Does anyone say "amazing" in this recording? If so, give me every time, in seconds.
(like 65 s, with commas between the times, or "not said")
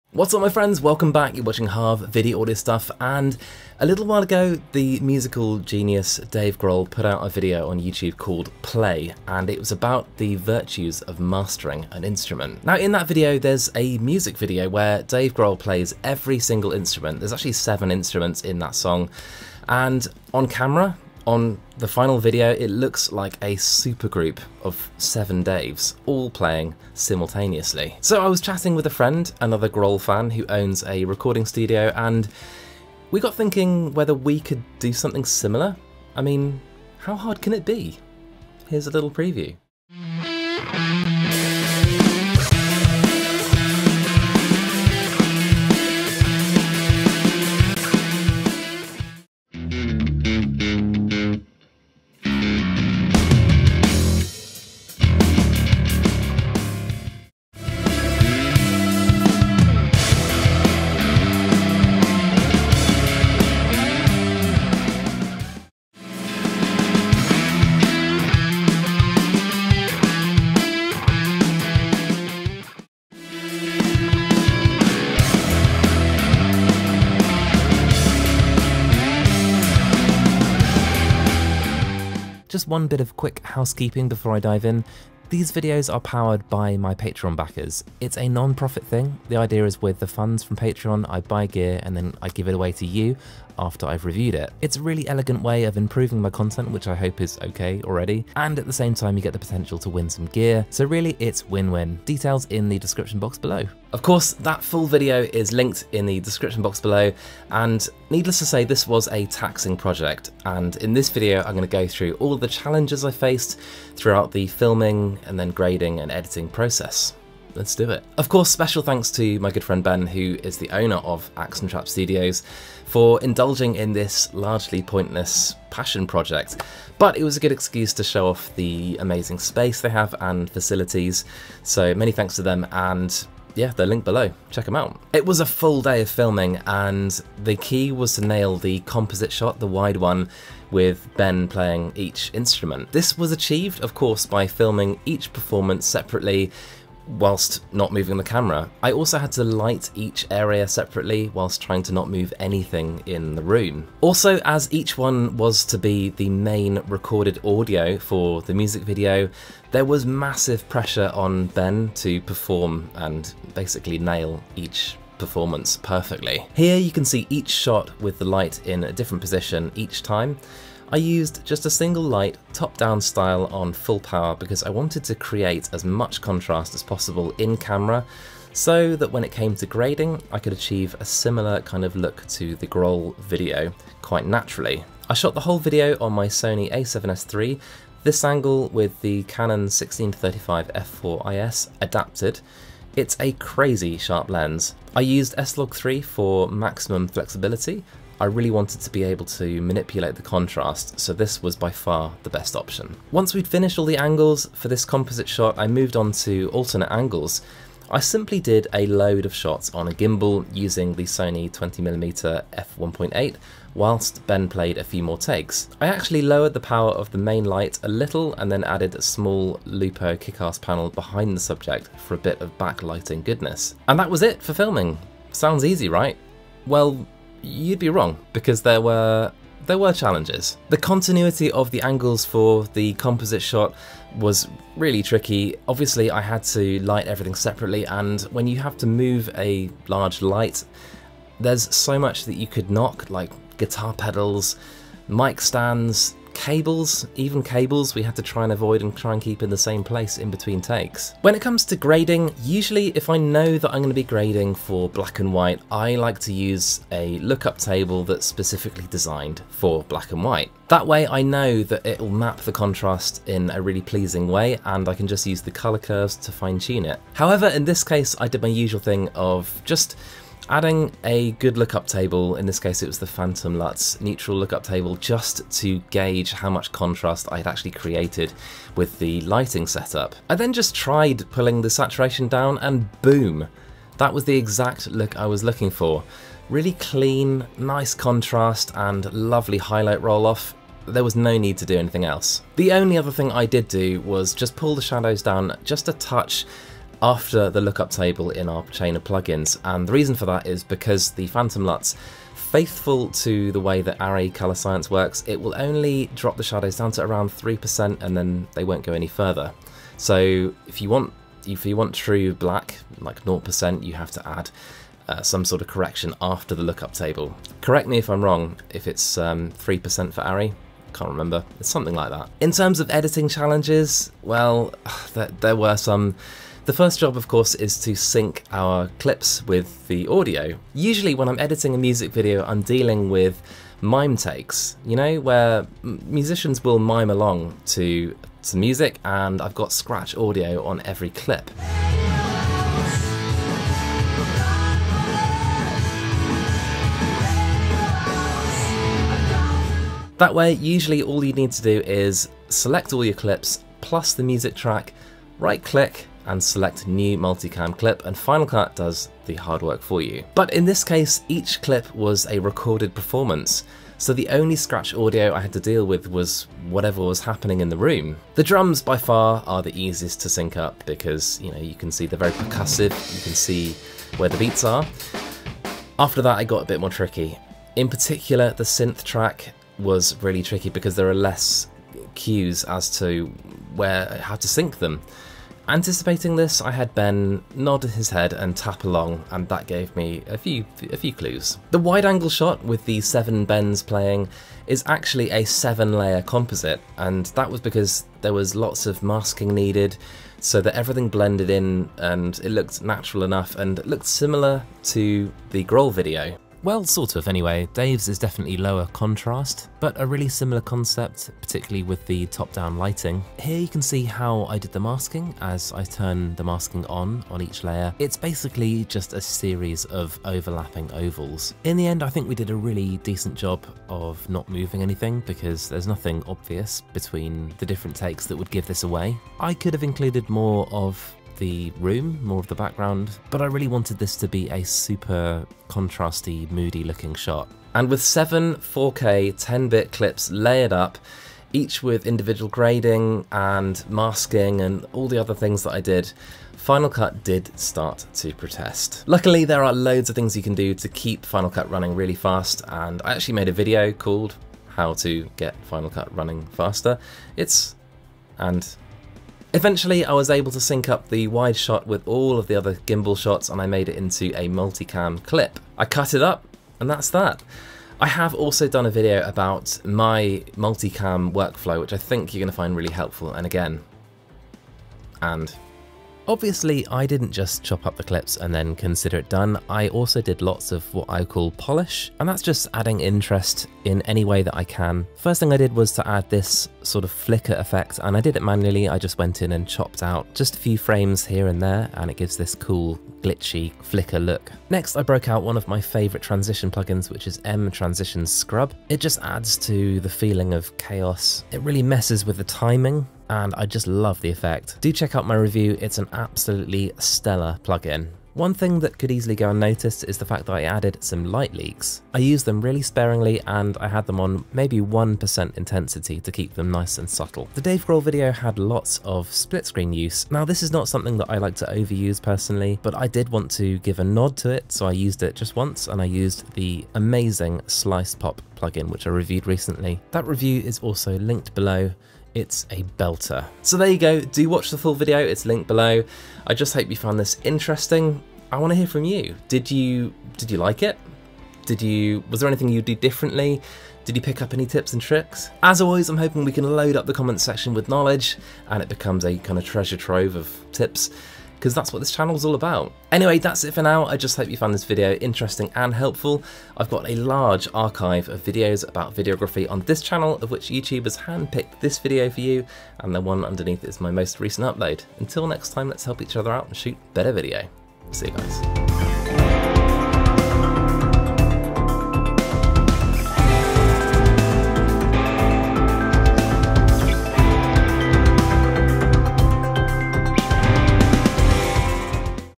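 129 s, 526 s.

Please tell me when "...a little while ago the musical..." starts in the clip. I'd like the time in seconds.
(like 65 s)
3 s.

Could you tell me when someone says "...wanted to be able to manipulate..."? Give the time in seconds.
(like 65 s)
198 s.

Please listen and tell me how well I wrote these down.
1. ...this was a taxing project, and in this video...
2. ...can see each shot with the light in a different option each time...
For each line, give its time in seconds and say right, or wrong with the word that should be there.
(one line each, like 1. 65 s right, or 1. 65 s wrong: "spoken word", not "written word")
1. 108 s right
2. 166 s wrong: "position", not "option".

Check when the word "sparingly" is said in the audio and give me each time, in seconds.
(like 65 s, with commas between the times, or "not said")
512 s.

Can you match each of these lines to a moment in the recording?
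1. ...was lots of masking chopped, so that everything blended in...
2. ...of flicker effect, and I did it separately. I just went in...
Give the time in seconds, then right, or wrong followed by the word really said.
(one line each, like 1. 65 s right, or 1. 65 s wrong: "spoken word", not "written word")
1. 398 s wrong: "needed", not "chopped"
2. 487 s wrong: "manually", not "separately".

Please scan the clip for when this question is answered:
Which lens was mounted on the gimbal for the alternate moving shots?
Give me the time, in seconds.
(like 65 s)
211 s.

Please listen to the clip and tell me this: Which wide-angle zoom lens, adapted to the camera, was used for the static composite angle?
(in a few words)
Canon 16-35 f4IS.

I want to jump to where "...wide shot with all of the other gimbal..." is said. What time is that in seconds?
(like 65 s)
461 s.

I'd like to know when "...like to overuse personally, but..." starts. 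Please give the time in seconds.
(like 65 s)
521 s.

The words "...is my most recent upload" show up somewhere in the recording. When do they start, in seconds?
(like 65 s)
563 s.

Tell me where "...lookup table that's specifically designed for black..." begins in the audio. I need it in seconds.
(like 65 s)
257 s.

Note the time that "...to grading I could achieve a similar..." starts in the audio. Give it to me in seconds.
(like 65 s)
179 s.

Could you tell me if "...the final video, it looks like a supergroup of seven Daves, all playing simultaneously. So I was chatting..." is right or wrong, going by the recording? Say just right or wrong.
right.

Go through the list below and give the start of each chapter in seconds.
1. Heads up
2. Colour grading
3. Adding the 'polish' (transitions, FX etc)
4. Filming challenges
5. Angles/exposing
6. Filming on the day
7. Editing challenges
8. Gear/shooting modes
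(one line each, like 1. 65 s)
1. 82 s
2. 251 s
3. 475 s
4. 230 s
5. 166 s
6. 135 s
7. 322 s
8. 185 s.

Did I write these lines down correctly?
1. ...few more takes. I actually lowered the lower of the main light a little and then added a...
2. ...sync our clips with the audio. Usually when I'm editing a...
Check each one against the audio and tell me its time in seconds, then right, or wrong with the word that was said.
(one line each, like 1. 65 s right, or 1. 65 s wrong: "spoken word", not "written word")
1. 214 s wrong: "power", not "lower"
2. 327 s right.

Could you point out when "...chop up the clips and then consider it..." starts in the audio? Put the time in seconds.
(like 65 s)
477 s.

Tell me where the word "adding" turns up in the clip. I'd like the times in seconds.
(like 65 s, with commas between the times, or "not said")
270 s, 482 s.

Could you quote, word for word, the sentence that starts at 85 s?
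These videos are powered by my Patreon backers.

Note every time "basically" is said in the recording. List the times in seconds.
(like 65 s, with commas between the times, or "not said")
163 s, 418 s.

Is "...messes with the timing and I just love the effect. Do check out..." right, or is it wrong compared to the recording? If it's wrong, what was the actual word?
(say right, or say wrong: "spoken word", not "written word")
right.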